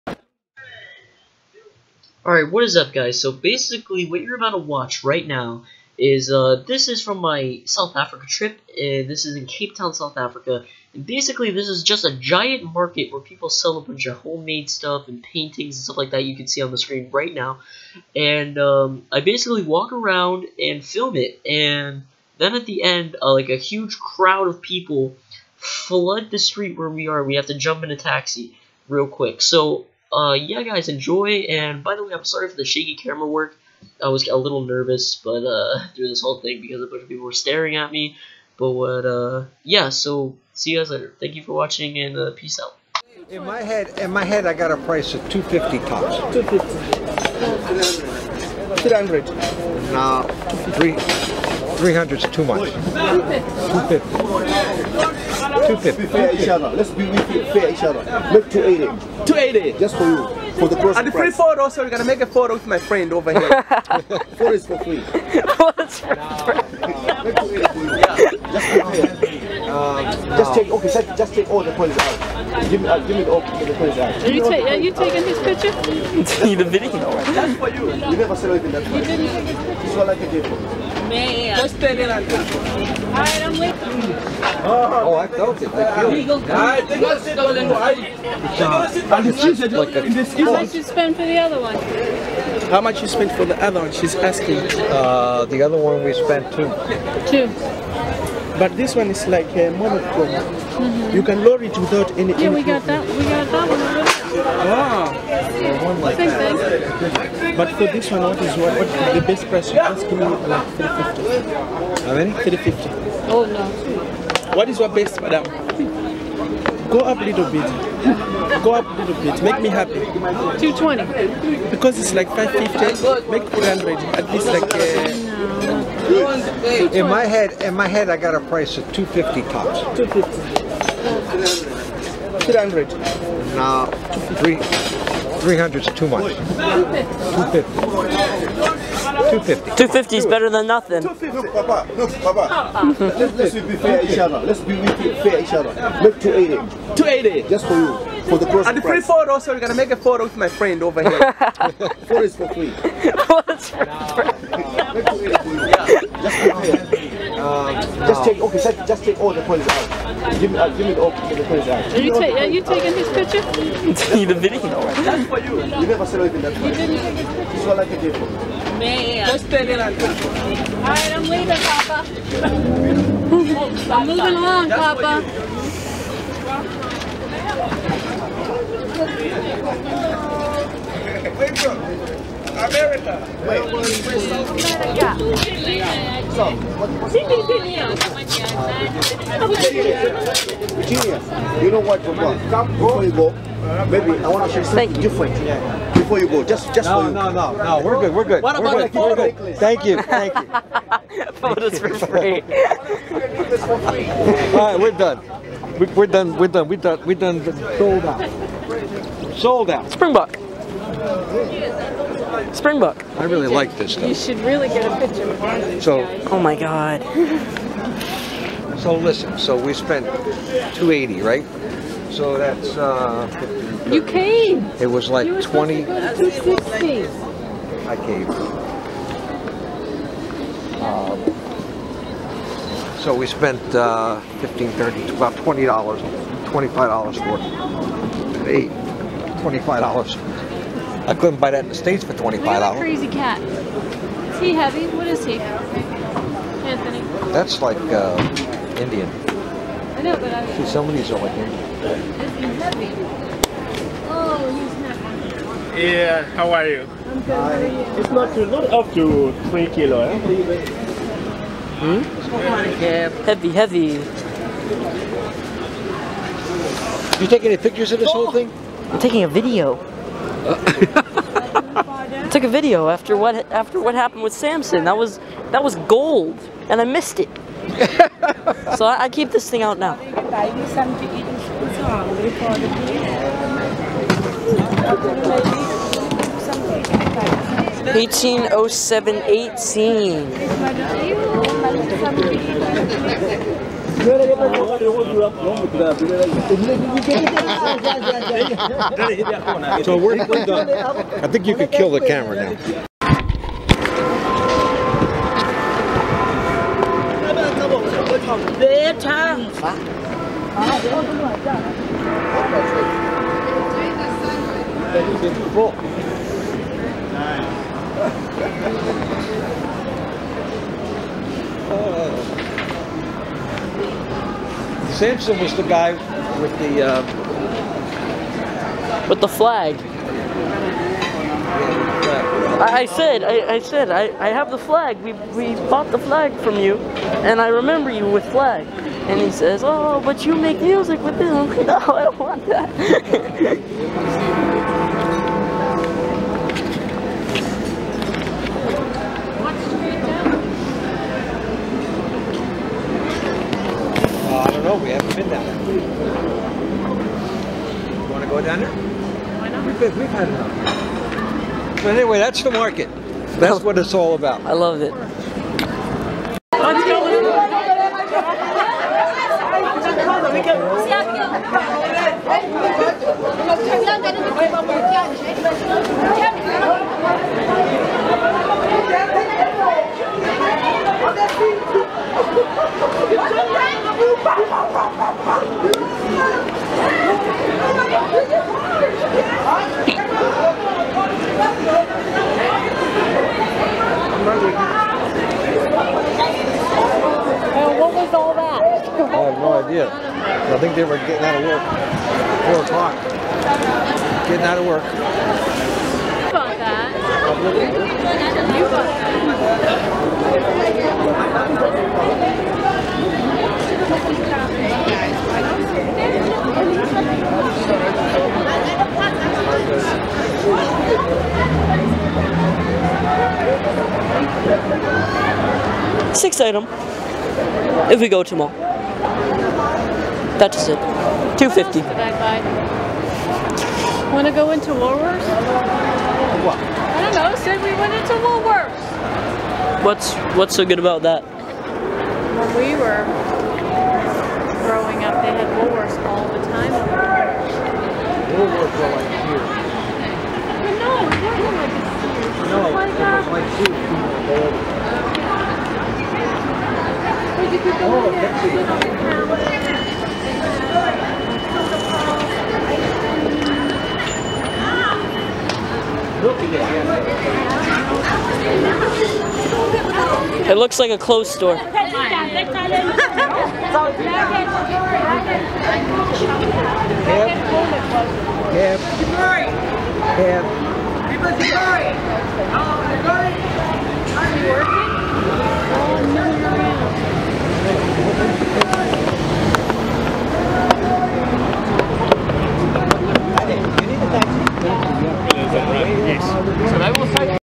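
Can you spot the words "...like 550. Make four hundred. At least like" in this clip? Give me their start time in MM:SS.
02:02.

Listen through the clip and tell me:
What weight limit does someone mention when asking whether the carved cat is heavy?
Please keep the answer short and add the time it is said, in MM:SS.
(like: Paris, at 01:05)
3 kilo, at 04:19.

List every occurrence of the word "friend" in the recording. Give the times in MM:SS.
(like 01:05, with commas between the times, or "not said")
01:02, 02:30.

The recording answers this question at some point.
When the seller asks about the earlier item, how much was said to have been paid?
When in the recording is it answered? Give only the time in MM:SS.
01:34.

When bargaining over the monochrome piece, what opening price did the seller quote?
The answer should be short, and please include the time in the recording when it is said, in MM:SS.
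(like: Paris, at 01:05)
350, at 01:49.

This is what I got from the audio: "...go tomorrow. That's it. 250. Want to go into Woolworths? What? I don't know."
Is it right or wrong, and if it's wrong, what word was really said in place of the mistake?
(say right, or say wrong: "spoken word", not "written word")
right.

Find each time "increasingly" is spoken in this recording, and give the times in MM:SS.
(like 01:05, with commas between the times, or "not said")
not said.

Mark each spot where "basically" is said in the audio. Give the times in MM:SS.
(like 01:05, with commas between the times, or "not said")
00:03, 00:11, 00:19.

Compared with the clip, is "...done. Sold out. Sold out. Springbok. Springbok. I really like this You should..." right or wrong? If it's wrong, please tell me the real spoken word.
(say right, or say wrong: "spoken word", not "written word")
right.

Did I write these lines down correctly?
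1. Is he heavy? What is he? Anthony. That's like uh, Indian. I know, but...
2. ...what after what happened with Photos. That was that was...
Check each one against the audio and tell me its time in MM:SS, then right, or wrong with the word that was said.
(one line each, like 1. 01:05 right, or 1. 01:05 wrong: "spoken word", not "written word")
1. 04:03 right
2. 04:33 wrong: "Samson", not "Photos".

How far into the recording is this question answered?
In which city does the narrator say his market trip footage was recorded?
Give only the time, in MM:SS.
00:09.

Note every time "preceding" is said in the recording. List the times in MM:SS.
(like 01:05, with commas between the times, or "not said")
not said.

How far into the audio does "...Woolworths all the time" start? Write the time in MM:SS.
07:25.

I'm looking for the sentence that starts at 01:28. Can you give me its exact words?
How much did you spend for the other one?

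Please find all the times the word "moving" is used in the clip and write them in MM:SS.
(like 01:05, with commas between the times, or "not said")
02:54.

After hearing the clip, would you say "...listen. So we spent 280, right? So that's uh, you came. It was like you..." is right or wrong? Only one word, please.
right.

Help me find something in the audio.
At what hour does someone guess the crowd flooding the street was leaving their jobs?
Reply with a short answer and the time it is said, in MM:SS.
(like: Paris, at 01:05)
4 o'clock, at 06:42.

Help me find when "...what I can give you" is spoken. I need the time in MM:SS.
02:47.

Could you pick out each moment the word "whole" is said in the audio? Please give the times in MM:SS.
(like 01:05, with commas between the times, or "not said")
00:36, 04:28.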